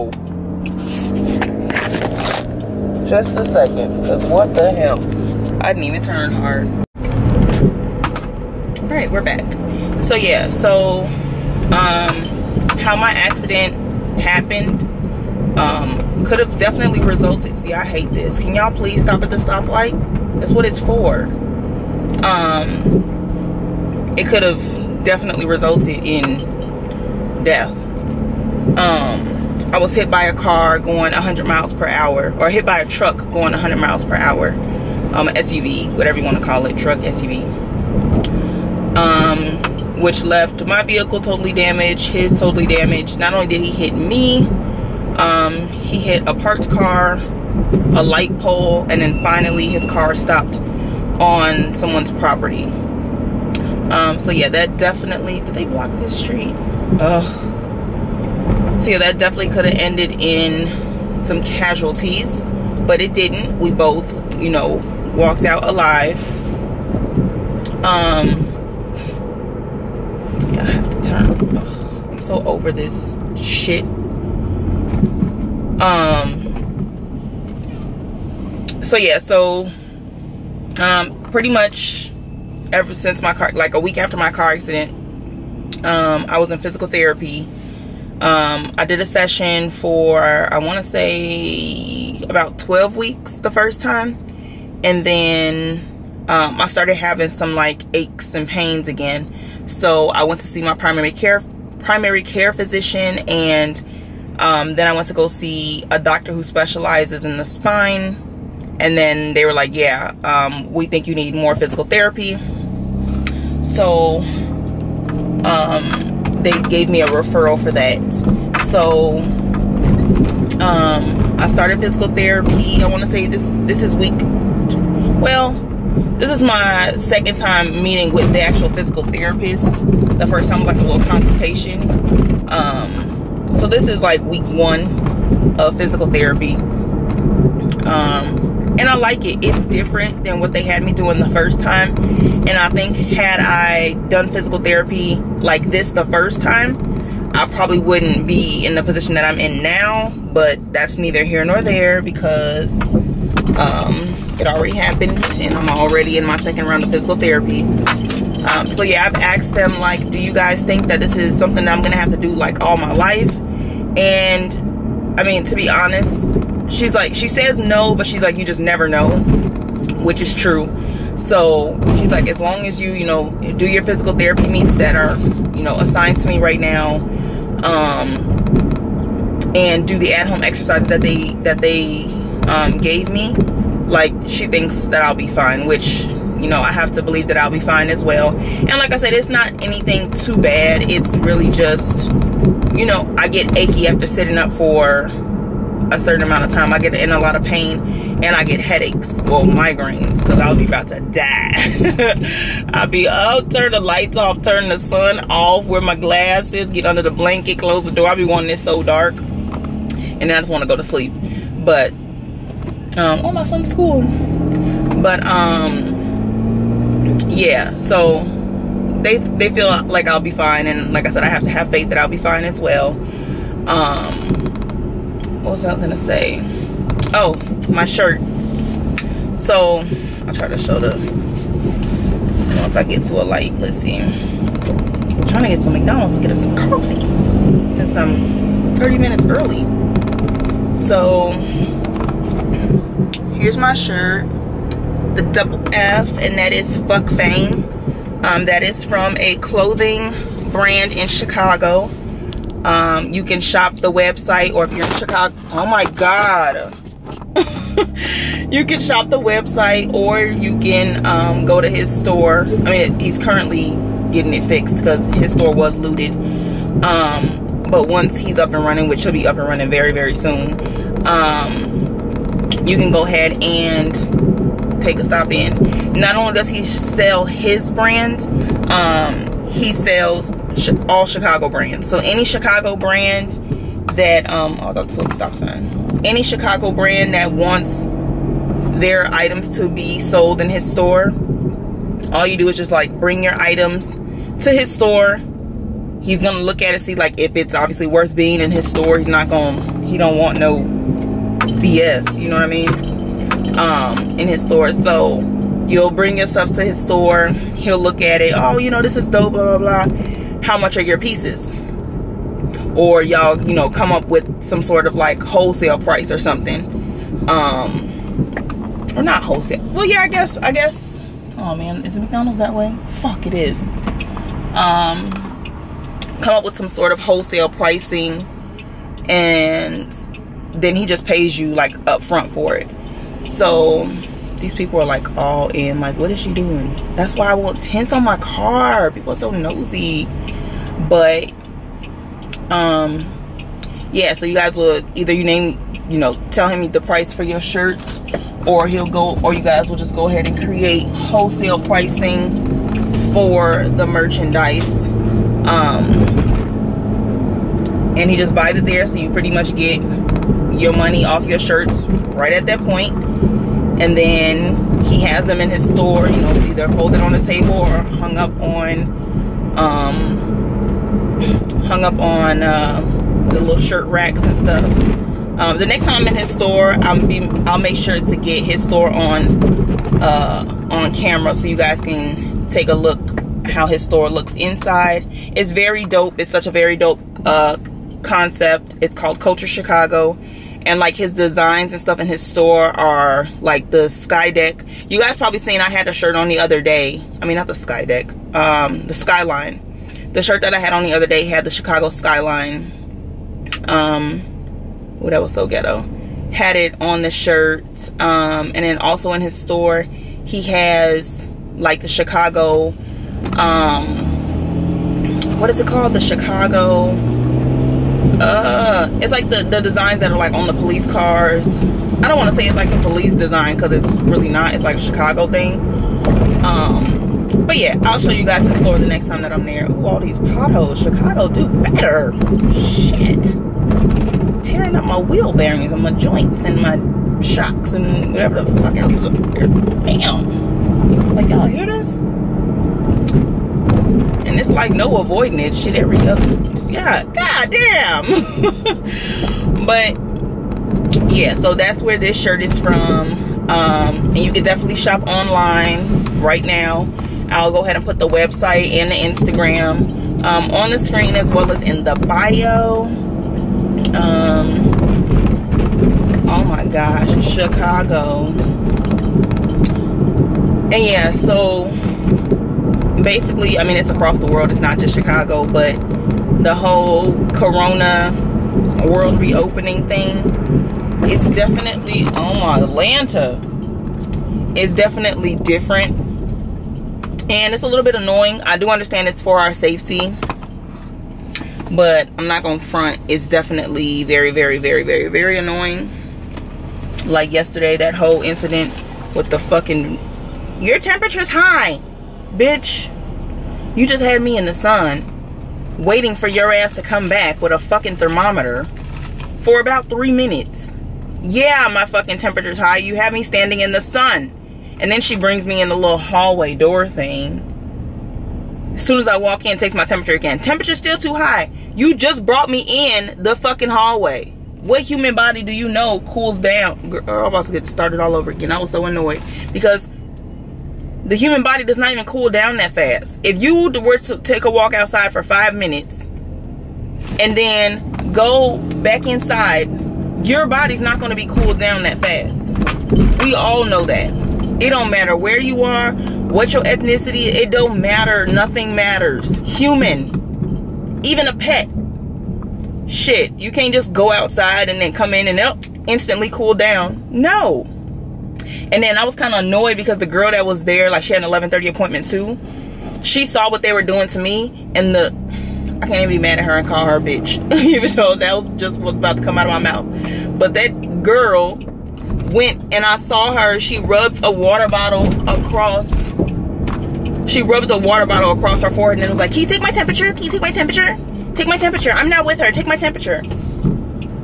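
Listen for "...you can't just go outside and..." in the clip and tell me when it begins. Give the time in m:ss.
9:13.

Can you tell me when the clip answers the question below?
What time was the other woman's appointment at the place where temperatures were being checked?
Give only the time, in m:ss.
9:21.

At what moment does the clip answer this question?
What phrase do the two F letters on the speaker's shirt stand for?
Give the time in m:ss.
4:06.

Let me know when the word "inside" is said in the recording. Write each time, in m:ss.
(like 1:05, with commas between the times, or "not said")
6:24, 8:59.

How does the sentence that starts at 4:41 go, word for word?
So any Chicago brand that, um, oh, that's a stop sign.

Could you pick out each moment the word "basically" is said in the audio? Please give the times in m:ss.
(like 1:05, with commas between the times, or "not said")
7:53.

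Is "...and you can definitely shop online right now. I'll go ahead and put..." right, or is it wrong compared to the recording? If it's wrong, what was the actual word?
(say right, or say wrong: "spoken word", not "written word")
right.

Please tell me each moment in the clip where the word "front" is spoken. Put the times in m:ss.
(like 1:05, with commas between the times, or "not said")
5:32, 8:12.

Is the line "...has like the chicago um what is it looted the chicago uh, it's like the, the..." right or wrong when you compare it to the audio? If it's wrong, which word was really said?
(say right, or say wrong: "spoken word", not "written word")
wrong: "called", not "looted".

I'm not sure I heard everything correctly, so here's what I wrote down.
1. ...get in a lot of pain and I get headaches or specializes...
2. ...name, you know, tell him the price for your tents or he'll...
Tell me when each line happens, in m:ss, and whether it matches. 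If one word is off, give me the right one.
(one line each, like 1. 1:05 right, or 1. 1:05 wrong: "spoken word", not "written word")
1. 3:16 wrong: "migraines", not "specializes"
2. 5:45 wrong: "shirts", not "tents".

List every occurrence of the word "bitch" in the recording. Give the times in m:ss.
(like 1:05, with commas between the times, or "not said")
8:22, 9:27.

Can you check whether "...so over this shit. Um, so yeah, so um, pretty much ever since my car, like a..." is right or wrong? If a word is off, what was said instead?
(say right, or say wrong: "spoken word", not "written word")
right.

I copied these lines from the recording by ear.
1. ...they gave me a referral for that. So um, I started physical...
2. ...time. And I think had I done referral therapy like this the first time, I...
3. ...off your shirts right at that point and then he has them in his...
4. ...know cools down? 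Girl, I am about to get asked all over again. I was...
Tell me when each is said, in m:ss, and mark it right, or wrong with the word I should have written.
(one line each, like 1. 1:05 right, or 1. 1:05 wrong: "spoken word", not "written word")
1. 1:56 right
2. 2:21 wrong: "physical", not "referral"
3. 6:01 right
4. 8:45 wrong: "started", not "asked".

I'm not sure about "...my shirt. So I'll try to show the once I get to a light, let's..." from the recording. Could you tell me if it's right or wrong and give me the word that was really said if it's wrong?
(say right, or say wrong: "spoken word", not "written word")
right.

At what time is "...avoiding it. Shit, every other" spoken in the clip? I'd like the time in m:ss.
7:24.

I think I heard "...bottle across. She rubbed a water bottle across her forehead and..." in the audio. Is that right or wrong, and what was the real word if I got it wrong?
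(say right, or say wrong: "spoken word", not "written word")
right.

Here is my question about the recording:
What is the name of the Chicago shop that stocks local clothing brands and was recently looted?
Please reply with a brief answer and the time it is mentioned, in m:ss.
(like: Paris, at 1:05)
Kulture Chicago, at 6:29.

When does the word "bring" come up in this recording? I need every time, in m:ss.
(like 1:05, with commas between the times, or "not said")
4:53, 5:05, 8:35.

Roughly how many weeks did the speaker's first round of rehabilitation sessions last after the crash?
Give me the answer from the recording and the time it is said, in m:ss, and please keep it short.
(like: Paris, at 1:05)
12 weeks, at 1:32.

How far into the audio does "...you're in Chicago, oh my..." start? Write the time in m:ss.
4:14.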